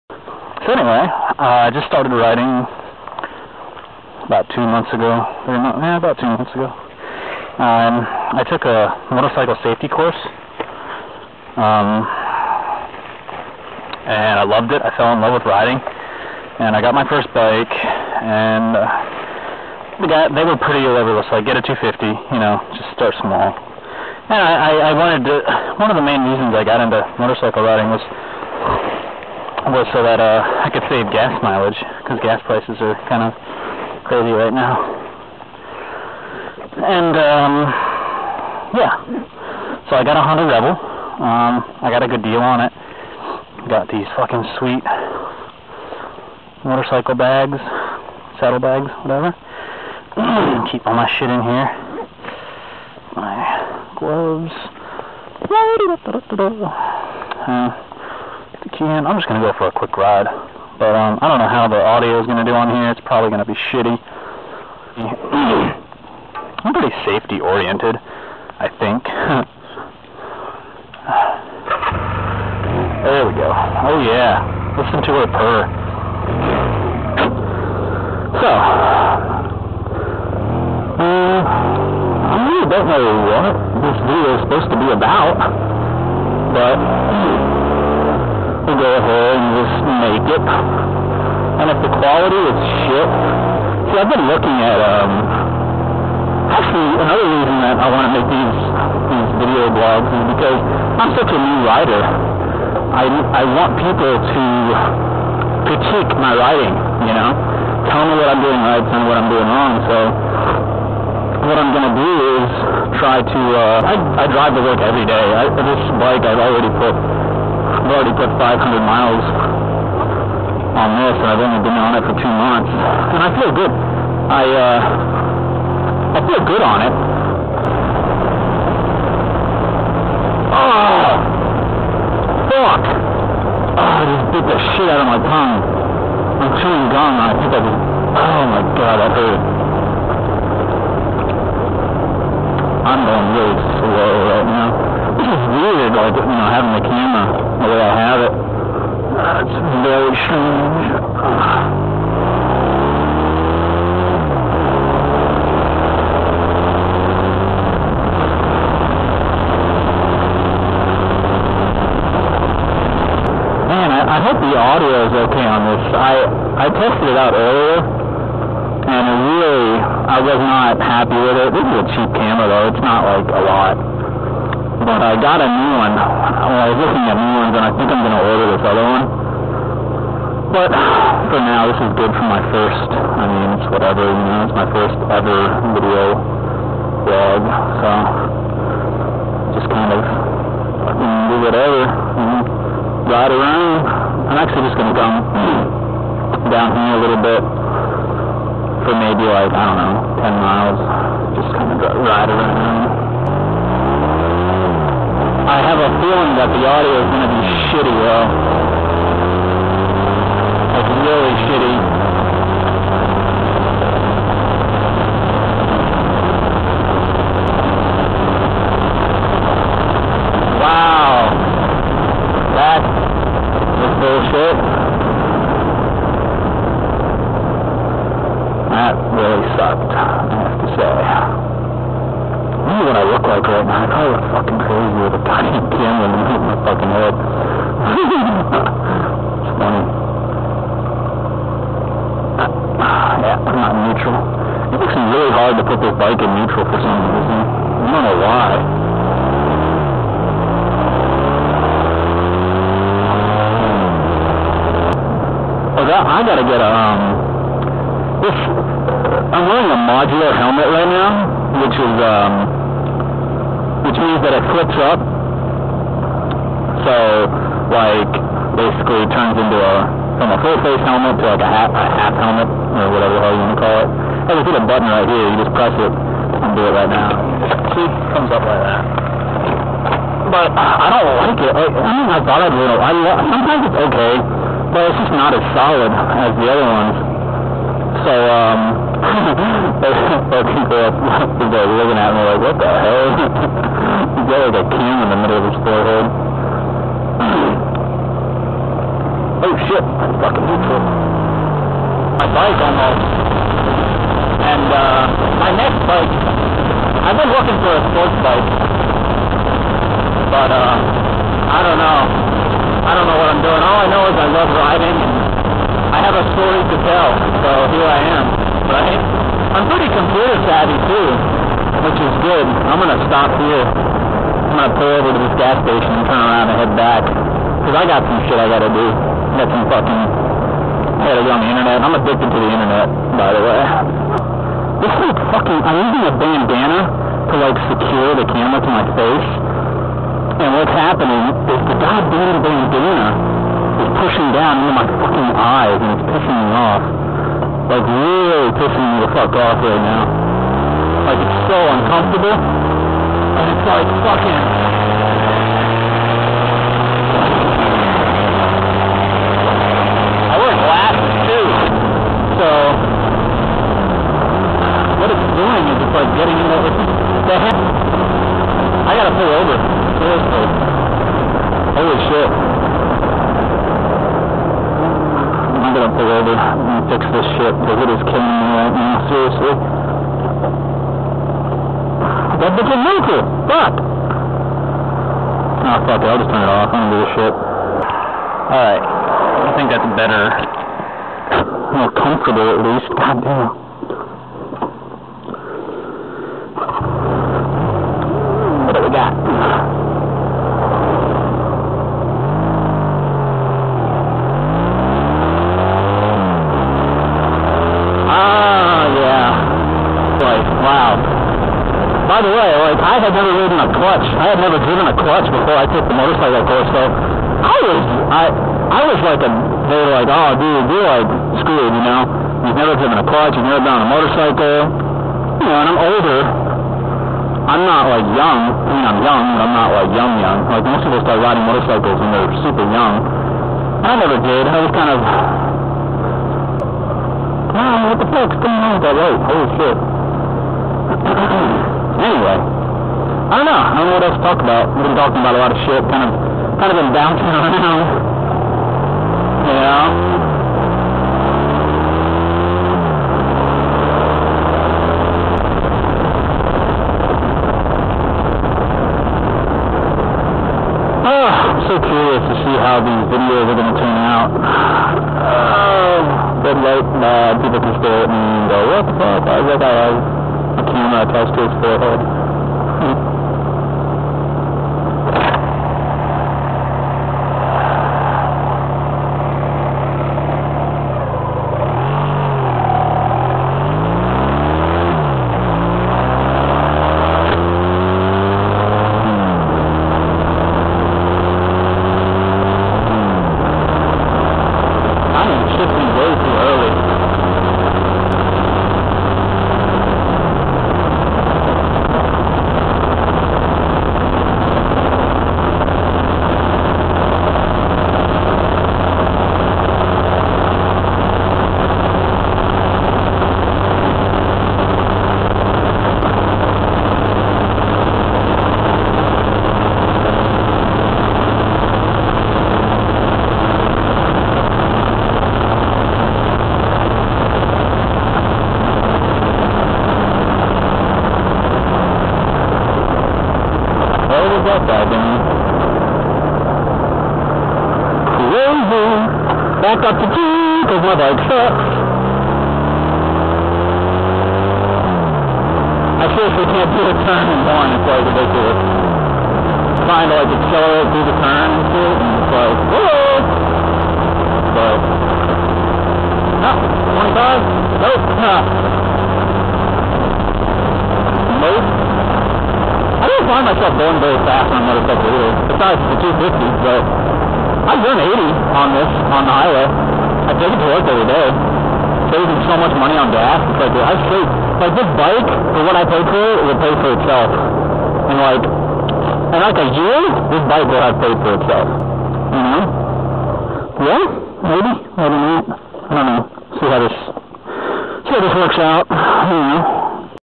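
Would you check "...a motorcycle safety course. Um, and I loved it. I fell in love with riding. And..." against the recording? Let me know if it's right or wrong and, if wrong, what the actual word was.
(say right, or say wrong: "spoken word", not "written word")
right.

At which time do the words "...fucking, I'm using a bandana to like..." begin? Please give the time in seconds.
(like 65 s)
335 s.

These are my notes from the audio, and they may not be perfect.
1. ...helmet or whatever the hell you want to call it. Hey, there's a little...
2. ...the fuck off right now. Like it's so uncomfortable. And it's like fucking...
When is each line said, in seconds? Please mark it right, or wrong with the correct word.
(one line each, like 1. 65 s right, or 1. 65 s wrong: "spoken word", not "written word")
1. 272 s right
2. 349 s right.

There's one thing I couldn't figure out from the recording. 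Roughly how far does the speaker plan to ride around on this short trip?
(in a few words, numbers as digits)
10 miles.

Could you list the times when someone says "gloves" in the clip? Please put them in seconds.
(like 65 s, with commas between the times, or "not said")
53 s.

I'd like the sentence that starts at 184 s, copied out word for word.
You know, it's my first ever video vlog, so just kind of whatever.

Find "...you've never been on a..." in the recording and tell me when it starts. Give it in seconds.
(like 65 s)
423 s.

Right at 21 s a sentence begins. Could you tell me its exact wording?
so I get a 250, you know, just start small.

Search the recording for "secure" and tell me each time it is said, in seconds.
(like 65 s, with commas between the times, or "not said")
337 s.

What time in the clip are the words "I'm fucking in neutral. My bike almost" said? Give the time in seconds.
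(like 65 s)
299 s.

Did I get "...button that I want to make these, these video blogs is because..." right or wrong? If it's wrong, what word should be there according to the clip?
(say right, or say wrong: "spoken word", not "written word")
wrong: "reason", not "button".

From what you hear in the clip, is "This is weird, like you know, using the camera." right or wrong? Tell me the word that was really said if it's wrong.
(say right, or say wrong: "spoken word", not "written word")
wrong: "having", not "using".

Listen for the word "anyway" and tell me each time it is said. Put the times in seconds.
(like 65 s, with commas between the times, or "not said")
0 s, 442 s.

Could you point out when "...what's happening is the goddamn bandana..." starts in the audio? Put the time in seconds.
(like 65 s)
340 s.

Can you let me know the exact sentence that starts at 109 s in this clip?
So, what I'm going to do is try to, uh, I, I drive to work every day.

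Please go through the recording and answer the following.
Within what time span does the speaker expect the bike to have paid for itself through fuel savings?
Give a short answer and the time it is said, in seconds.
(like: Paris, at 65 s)
a year, at 579 s.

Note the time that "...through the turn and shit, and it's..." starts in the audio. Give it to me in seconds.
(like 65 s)
550 s.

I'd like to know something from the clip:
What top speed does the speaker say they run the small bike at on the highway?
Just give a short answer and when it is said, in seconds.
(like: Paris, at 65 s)
80, at 568 s.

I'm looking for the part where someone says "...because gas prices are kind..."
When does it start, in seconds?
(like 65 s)
32 s.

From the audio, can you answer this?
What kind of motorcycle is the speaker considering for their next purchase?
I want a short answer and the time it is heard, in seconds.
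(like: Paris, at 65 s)
sports bike, at 307 s.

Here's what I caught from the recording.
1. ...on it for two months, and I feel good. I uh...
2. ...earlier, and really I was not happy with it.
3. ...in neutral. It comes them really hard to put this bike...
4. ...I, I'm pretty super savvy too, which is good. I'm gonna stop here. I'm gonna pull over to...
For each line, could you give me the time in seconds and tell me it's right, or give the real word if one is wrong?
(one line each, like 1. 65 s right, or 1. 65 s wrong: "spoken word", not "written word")
1. 121 s right
2. 167 s right
3. 243 s wrong: "makes", not "comes"
4. 318 s wrong: "computer", not "super".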